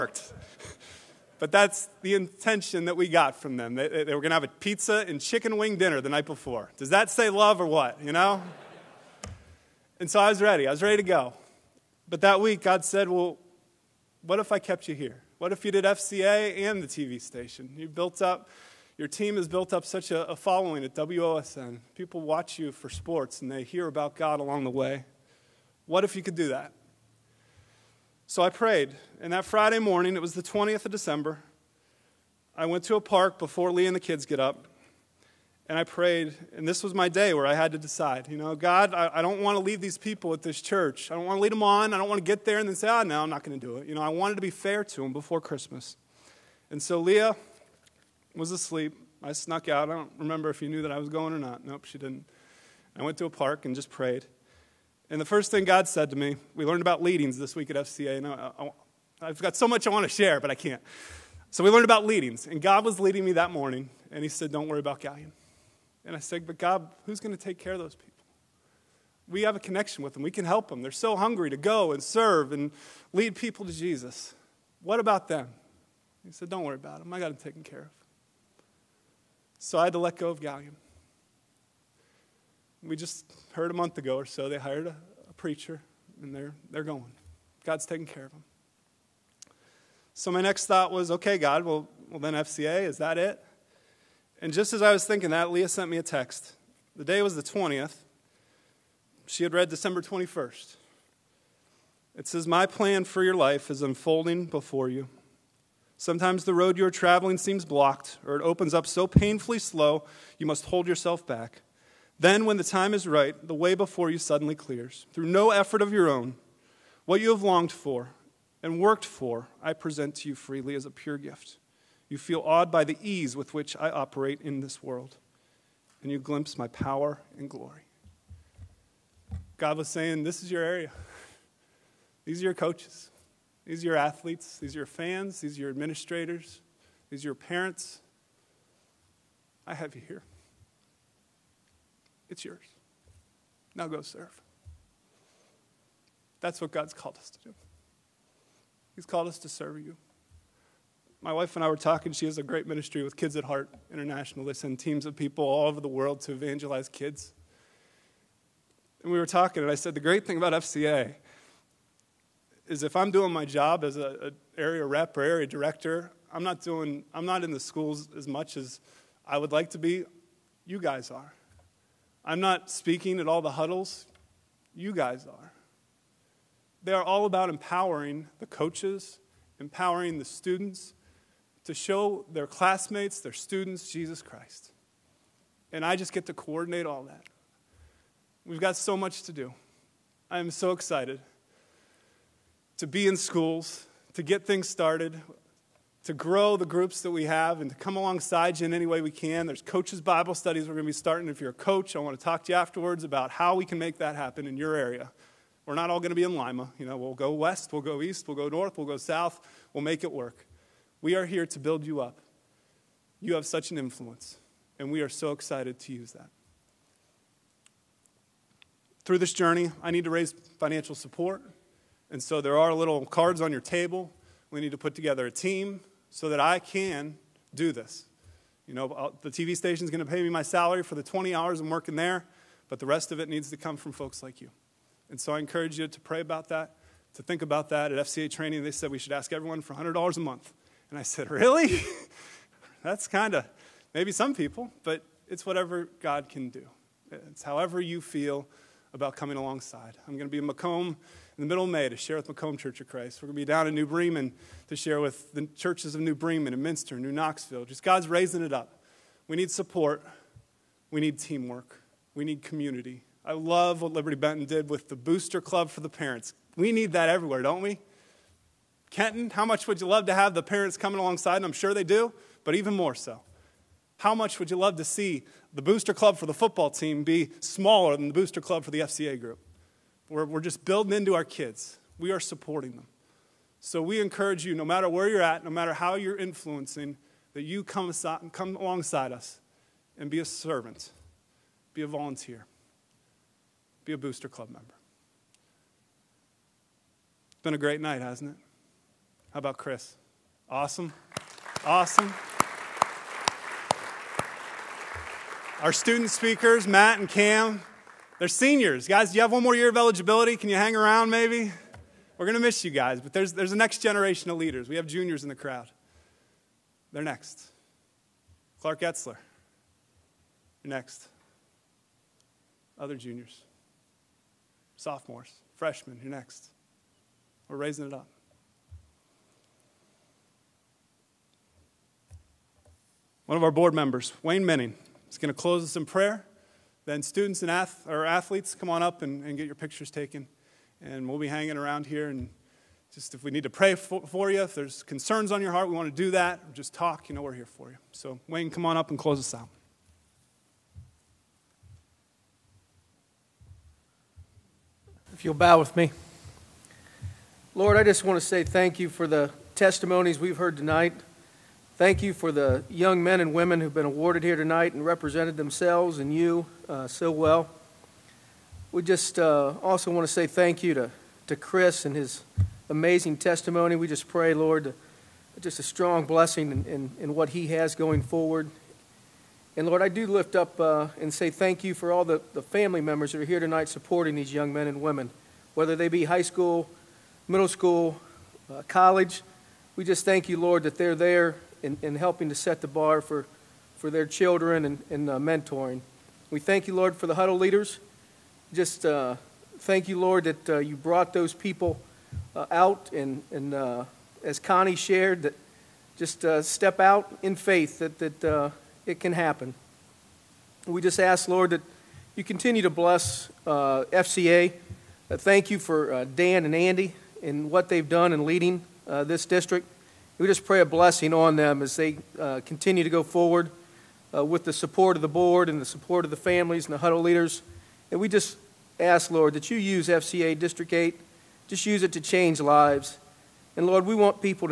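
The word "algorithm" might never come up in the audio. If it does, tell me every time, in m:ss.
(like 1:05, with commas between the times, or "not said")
not said.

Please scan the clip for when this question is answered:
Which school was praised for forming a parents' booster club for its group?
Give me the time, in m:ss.
4:23.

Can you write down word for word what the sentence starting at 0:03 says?
They, they were going to have a pizza and chicken wing dinner the night before.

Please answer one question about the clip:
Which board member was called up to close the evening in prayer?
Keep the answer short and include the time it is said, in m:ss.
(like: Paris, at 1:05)
Wayne Menning, at 5:34.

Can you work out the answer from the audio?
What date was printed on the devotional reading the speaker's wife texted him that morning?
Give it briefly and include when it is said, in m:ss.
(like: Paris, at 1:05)
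December 21st, at 1:39.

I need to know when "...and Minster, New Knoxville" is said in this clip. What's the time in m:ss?
4:16.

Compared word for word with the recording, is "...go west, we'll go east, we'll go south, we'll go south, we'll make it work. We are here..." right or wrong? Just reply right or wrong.
wrong.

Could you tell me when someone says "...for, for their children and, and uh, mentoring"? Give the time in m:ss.
6:33.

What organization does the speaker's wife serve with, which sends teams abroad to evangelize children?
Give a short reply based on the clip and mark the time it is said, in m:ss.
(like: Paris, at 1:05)
Kids at Heart International, at 2:33.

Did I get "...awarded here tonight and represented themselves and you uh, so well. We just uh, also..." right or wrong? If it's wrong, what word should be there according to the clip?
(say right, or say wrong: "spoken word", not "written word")
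right.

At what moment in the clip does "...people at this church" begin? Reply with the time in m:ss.
0:39.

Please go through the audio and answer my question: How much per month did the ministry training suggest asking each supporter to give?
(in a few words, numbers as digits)
$100.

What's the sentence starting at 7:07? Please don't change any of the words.
And we just ask, Lord, that you use FCA District 8, just use it to change lives.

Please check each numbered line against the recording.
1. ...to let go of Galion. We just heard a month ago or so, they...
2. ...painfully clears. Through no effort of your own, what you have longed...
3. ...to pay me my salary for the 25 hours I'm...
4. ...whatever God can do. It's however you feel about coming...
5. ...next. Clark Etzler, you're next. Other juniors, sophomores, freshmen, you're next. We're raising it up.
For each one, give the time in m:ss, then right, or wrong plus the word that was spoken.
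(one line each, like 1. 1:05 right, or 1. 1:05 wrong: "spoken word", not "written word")
1. 1:19 right
2. 1:54 wrong: "suddenly", not "painfully"
3. 3:50 wrong: "20", not "25"
4. 4:05 right
5. 5:17 right.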